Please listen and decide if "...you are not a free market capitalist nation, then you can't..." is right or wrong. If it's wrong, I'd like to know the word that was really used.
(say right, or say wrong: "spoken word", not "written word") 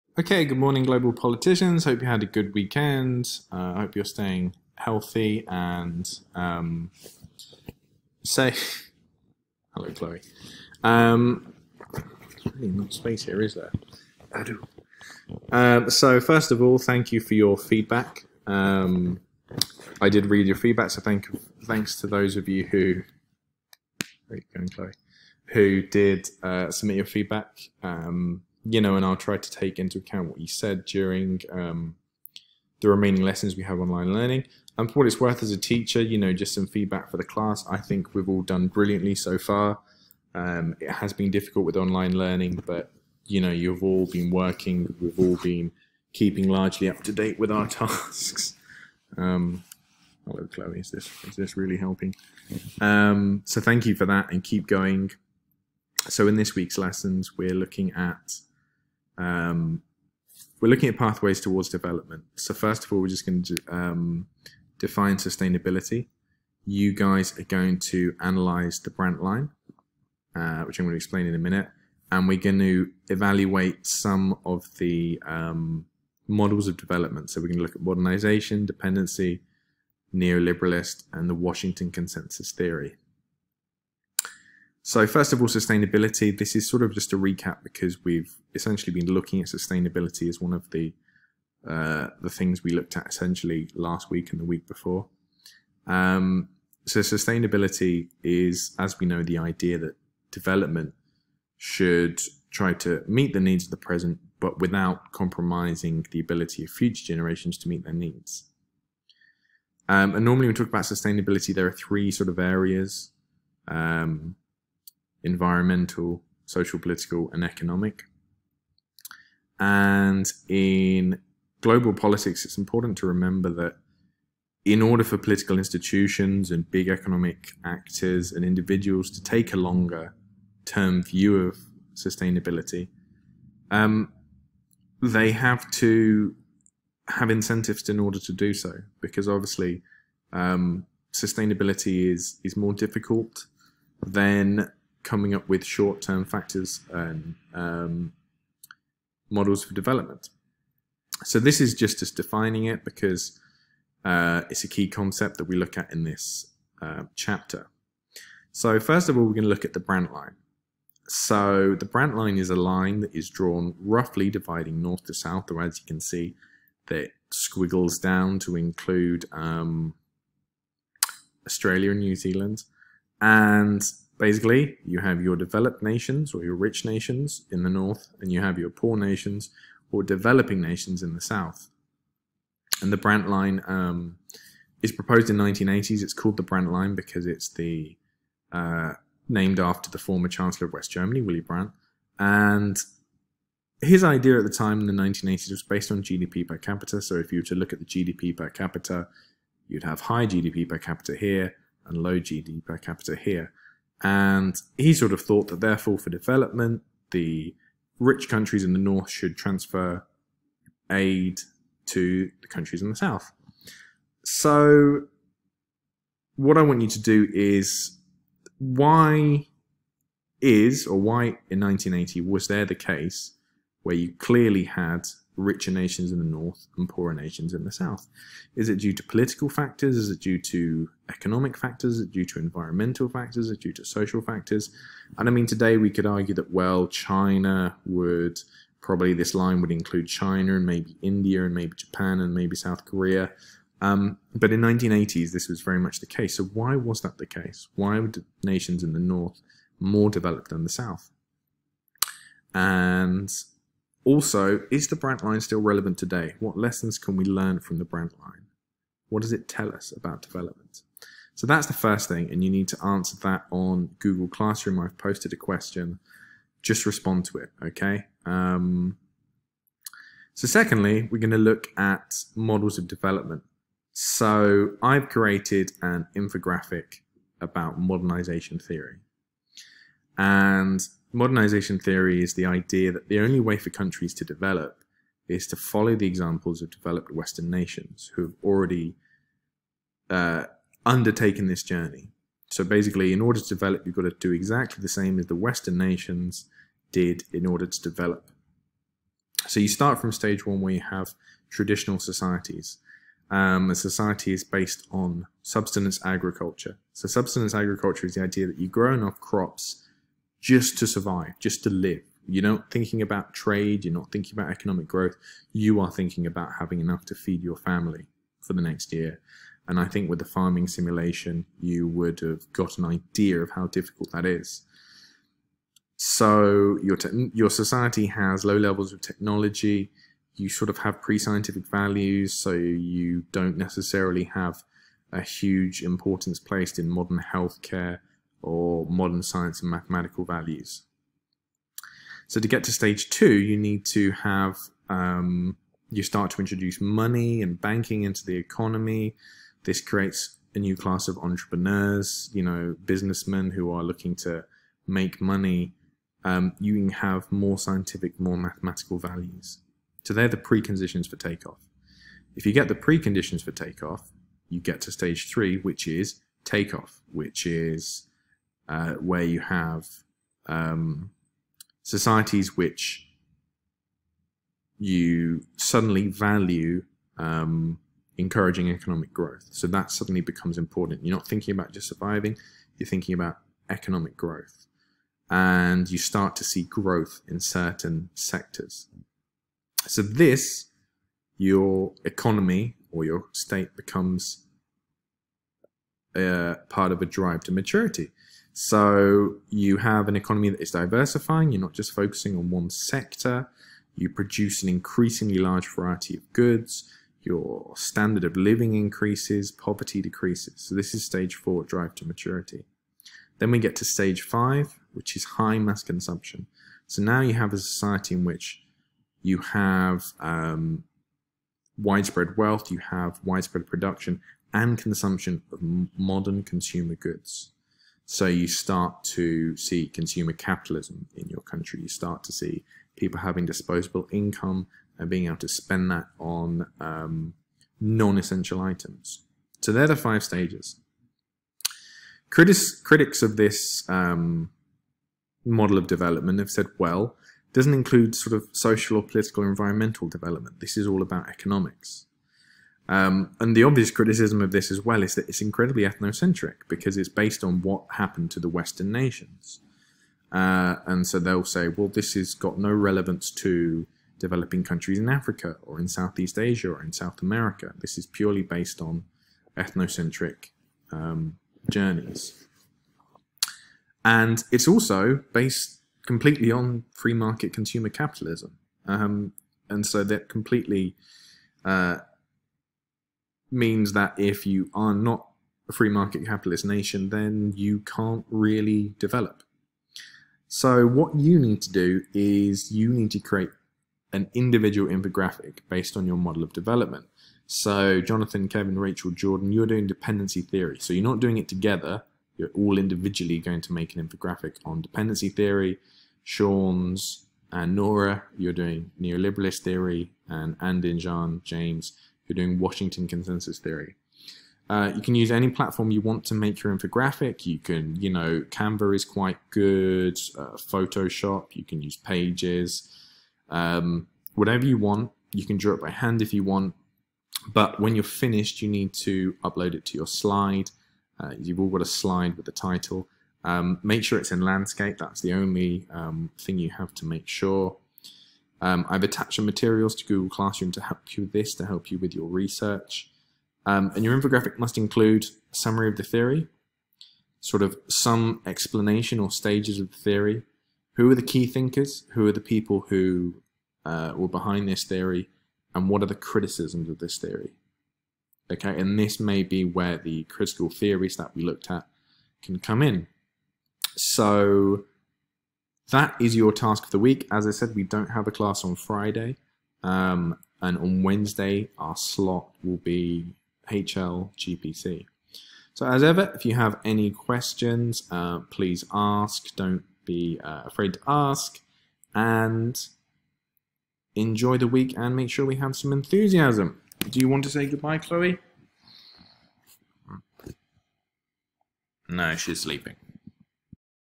right.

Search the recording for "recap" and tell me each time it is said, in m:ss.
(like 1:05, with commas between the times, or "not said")
1:27.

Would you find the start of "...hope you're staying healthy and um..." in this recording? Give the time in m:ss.
0:03.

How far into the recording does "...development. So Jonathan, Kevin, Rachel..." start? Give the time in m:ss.
8:16.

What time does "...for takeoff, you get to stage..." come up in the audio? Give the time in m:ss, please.
6:03.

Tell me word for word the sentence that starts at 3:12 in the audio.
And his idea at the time in the 1980s was based on GDP per capita.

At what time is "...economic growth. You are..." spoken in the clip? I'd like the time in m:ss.
5:14.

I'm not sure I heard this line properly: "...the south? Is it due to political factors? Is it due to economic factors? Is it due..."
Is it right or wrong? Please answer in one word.
right.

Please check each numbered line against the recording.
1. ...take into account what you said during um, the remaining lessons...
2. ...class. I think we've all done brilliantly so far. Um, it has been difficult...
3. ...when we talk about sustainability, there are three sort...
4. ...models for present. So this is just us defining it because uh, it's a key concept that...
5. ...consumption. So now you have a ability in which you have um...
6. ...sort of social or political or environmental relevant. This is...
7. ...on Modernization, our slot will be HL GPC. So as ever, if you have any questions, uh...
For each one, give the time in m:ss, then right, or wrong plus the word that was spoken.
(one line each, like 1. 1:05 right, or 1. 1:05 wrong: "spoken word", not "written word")
1. 0:29 right
2. 0:37 right
3. 1:50 right
4. 2:29 wrong: "development", not "present"
5. 6:55 wrong: "society", not "ability"
6. 7:28 wrong: "development", not "relevant"
7. 9:30 wrong: "Wednesday", not "Modernization".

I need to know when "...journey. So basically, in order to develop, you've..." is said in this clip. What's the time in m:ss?
4:51.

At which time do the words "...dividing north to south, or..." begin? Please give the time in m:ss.
2:44.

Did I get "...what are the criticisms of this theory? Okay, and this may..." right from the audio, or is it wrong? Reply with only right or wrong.
right.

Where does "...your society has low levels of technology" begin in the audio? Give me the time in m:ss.
5:27.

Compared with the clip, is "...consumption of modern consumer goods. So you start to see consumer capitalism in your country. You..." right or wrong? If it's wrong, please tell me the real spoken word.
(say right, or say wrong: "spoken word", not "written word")
right.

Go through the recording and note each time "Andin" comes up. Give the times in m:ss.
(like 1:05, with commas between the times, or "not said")
8:30.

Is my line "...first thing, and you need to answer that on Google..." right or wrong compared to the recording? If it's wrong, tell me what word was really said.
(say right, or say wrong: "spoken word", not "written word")
right.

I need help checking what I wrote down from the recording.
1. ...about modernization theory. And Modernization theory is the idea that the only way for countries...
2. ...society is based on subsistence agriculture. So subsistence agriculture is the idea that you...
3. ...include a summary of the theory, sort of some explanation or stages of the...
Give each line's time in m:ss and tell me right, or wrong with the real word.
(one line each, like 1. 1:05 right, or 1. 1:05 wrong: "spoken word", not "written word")
1. 4:37 right
2. 5:03 right
3. 9:04 right.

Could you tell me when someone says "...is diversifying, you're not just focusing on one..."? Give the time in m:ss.
6:40.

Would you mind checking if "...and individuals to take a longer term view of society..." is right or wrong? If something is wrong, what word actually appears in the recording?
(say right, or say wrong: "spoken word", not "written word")
wrong: "sustainability", not "society".